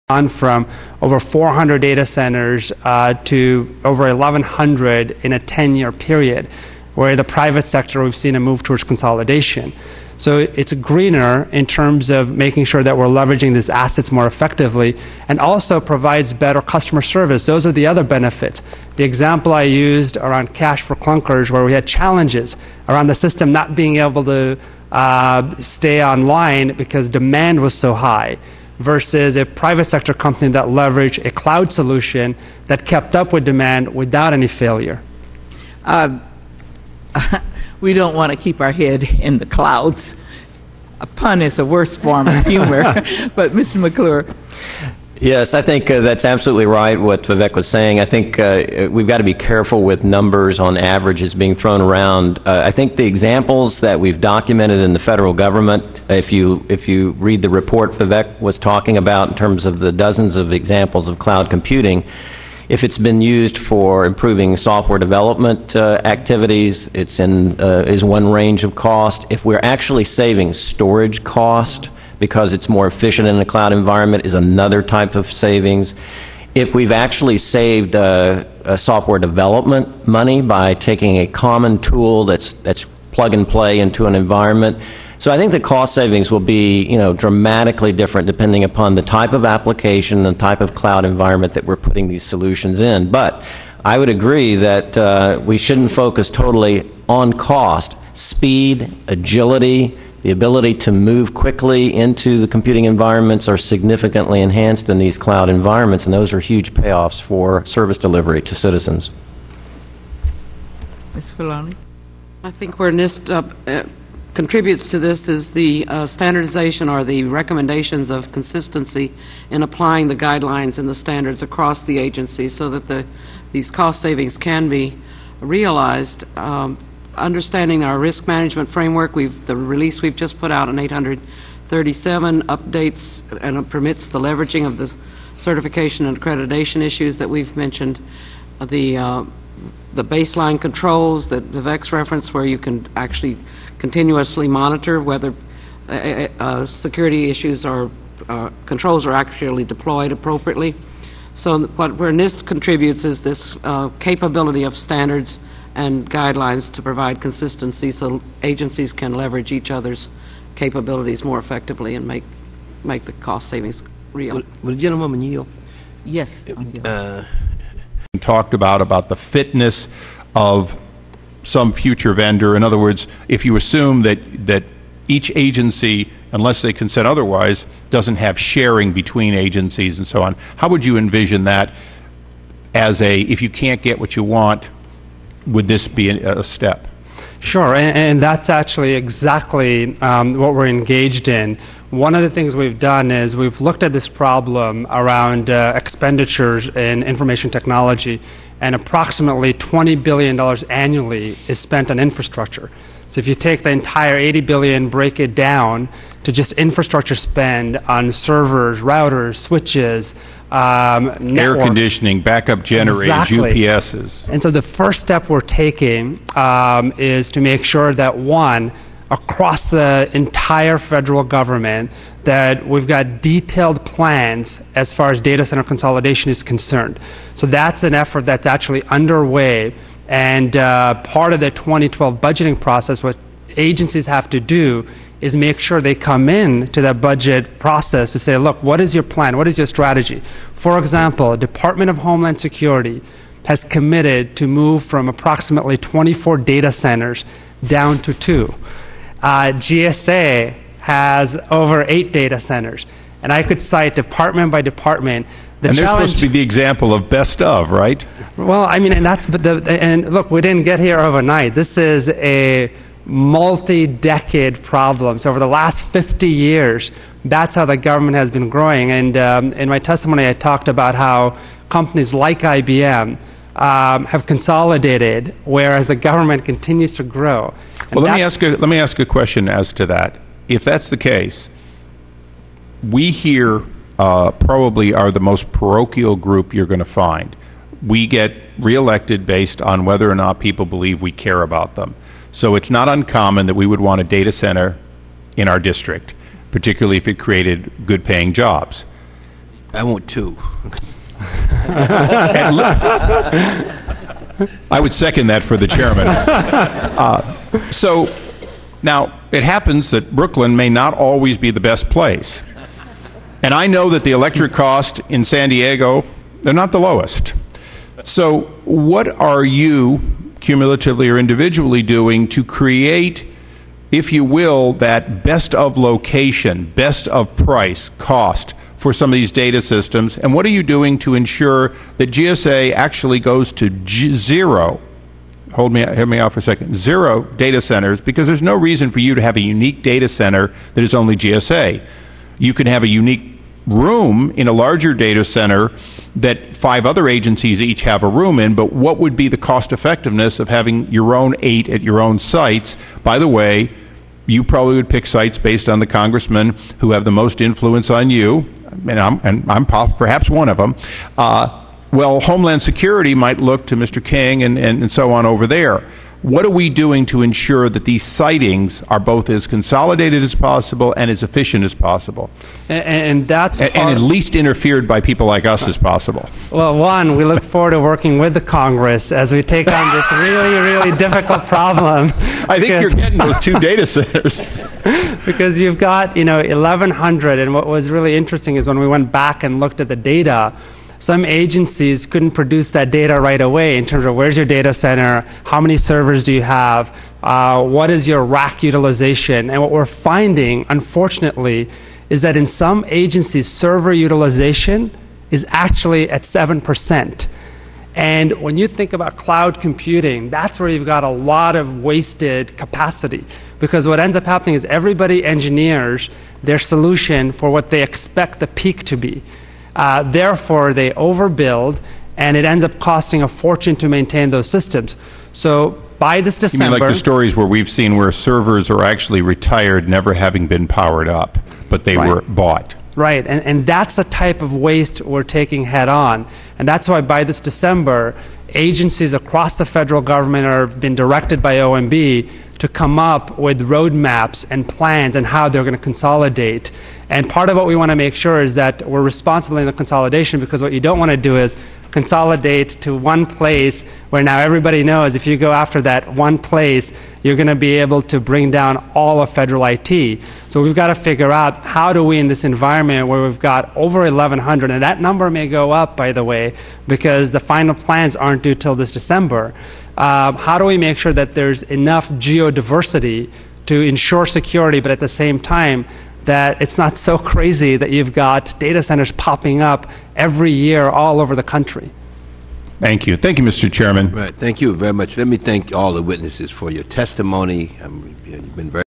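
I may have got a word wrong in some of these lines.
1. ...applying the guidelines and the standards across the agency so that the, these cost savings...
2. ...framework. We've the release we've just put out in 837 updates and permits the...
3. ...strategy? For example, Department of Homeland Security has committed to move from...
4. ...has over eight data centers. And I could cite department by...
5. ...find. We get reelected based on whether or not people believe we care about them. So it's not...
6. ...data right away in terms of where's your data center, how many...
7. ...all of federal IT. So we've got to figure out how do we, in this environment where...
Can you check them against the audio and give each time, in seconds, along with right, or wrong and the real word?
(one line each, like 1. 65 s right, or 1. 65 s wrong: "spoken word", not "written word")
1. 119 s right
2. 128 s right
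3. 239 s right
4. 250 s right
5. 286 s right
6. 392 s right
7. 458 s right.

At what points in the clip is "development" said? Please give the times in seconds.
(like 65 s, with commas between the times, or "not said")
64 s, 79 s.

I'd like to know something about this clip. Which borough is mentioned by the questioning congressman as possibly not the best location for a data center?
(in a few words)
Brooklyn.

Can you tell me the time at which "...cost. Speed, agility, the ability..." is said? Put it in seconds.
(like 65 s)
97 s.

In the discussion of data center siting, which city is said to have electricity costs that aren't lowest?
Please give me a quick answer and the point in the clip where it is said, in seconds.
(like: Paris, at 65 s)
San Diego, at 315 s.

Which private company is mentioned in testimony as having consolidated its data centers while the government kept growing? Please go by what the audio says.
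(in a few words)
IBM.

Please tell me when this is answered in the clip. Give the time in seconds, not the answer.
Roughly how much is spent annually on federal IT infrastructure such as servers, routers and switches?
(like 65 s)
199 s.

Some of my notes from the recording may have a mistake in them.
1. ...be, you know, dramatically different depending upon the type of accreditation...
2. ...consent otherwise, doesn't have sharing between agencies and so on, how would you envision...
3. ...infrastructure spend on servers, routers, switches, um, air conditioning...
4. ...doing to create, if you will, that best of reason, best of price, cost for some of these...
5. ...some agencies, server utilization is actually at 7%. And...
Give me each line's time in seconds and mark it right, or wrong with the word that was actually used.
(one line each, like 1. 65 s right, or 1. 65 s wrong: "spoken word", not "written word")
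1. 86 s wrong: "application", not "accreditation"
2. 176 s right
3. 206 s right
4. 321 s wrong: "location", not "reason"
5. 402 s right.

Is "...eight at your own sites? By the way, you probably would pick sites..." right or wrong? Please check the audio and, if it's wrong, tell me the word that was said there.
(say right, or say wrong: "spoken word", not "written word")
right.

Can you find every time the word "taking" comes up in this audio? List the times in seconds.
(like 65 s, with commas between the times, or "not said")
80 s, 215 s, 435 s.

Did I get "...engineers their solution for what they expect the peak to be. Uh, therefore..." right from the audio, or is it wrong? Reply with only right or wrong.
right.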